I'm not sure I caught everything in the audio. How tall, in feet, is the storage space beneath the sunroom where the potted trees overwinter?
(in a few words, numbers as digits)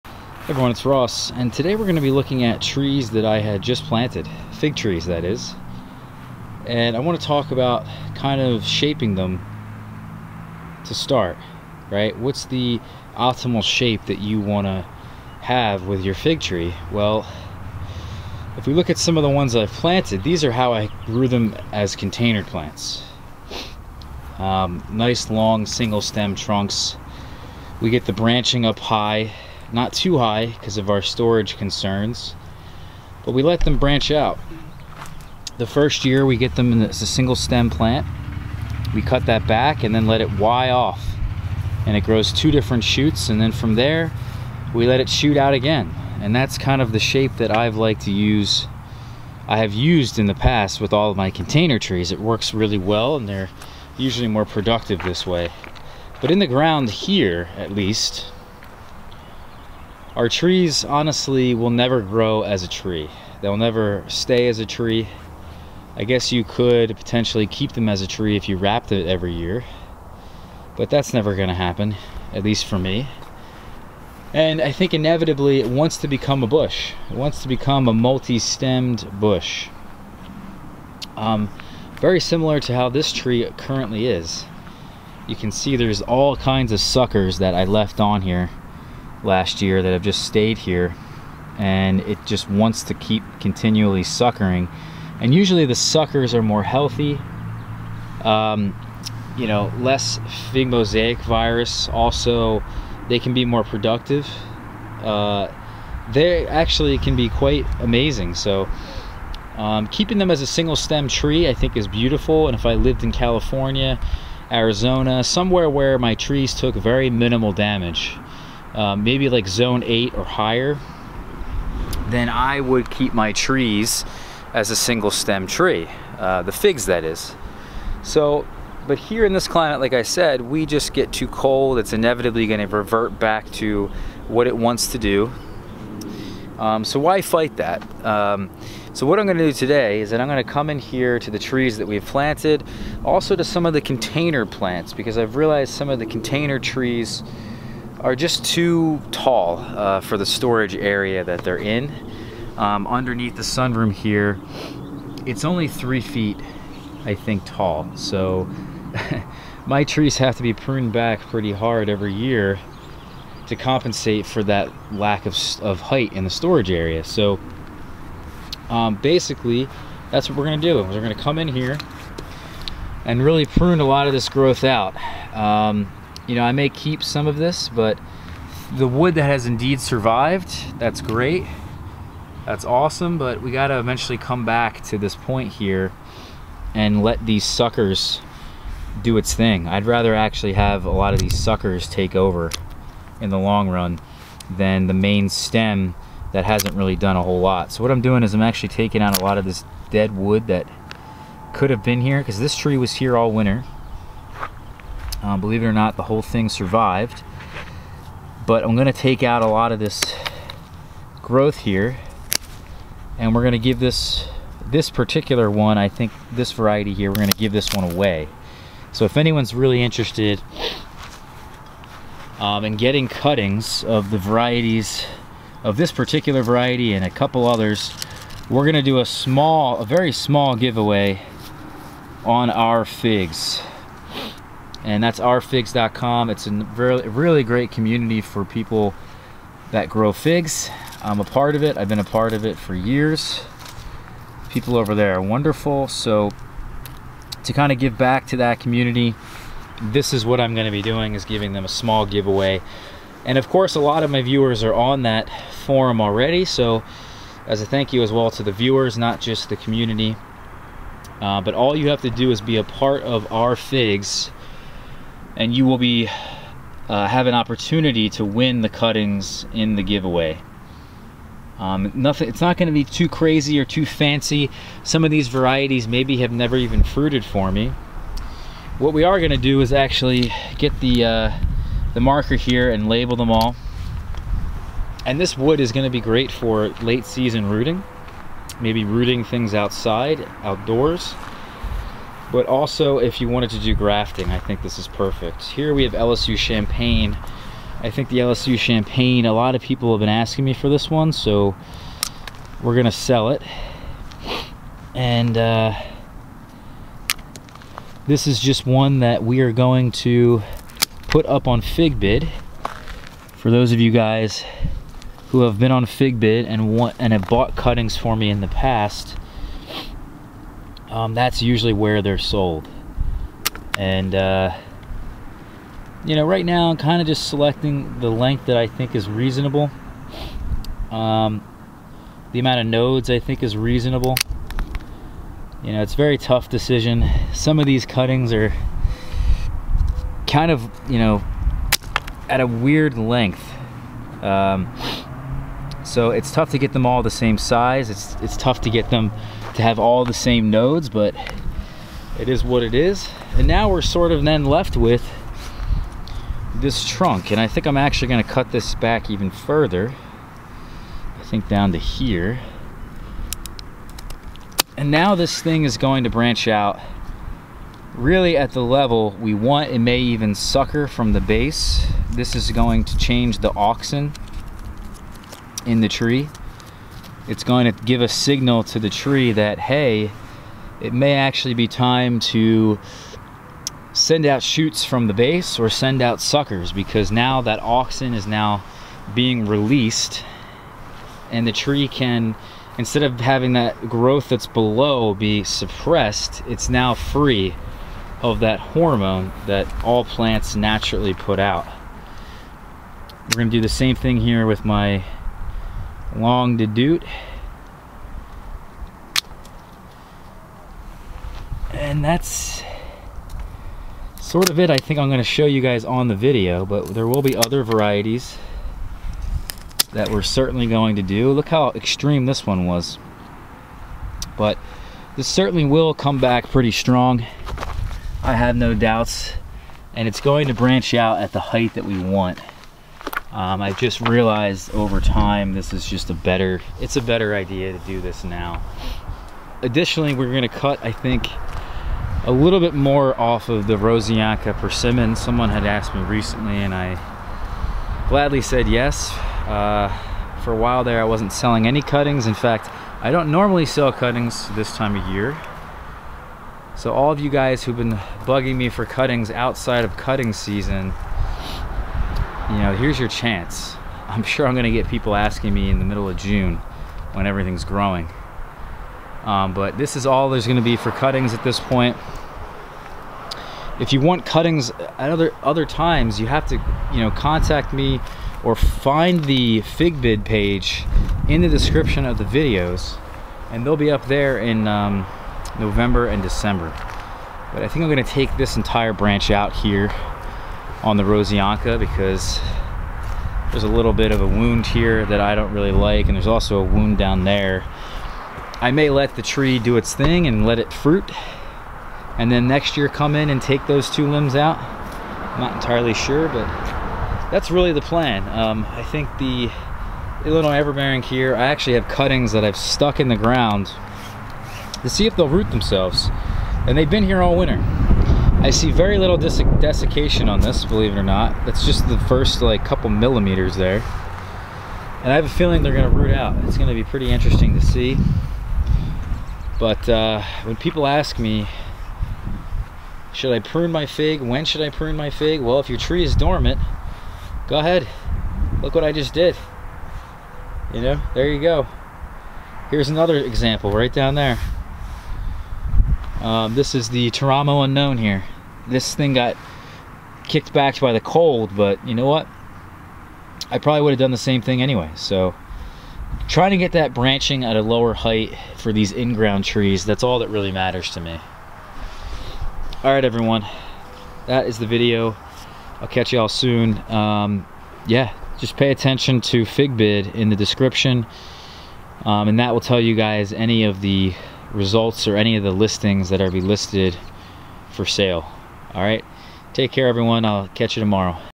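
3 feet.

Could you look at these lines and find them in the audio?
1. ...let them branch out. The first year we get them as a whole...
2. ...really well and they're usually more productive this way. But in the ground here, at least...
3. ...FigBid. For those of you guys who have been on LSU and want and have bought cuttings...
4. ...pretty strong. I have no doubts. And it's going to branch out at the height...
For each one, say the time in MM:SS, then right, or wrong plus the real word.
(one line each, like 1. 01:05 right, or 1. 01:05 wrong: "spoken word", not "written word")
1. 00:33 wrong: "single", not "whole"
2. 00:52 right
3. 05:11 wrong: "FigBid", not "LSU"
4. 07:06 right.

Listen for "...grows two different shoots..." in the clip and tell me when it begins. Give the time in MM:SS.
00:42.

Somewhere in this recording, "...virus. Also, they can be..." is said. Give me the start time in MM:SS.
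01:41.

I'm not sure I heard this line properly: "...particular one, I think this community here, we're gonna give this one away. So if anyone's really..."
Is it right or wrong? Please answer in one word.
wrong.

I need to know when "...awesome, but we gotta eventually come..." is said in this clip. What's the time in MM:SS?
03:02.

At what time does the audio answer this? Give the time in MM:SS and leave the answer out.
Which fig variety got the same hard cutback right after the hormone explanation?
06:46.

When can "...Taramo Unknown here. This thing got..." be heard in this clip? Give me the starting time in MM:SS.
09:07.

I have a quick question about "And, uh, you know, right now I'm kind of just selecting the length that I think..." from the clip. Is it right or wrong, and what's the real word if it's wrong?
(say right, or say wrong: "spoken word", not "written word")
right.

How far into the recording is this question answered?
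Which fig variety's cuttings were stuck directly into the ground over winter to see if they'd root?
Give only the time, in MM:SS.
08:30.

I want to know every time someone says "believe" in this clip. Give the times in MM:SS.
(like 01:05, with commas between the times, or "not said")
03:25, 08:40.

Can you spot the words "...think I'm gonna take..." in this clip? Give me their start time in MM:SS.
08:07.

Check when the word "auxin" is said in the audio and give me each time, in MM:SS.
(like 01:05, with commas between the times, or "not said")
06:13, 06:27.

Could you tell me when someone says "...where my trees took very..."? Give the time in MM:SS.
01:55.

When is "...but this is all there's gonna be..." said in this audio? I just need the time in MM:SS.
07:49.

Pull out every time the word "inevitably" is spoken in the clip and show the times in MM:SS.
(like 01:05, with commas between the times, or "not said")
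01:14, 02:11.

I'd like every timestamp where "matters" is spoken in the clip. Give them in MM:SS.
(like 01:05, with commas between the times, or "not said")
09:20.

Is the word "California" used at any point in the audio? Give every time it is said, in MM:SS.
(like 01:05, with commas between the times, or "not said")
01:53.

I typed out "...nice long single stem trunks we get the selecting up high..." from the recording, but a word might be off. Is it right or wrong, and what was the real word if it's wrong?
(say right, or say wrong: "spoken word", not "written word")
wrong: "branching", not "selecting".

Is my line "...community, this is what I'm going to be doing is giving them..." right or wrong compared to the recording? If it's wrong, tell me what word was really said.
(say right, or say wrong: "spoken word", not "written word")
right.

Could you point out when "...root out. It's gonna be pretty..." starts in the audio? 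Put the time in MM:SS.
08:45.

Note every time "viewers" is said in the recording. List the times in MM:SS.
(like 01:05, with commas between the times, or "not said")
04:14, 04:18.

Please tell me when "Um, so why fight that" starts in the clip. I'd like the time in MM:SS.
02:16.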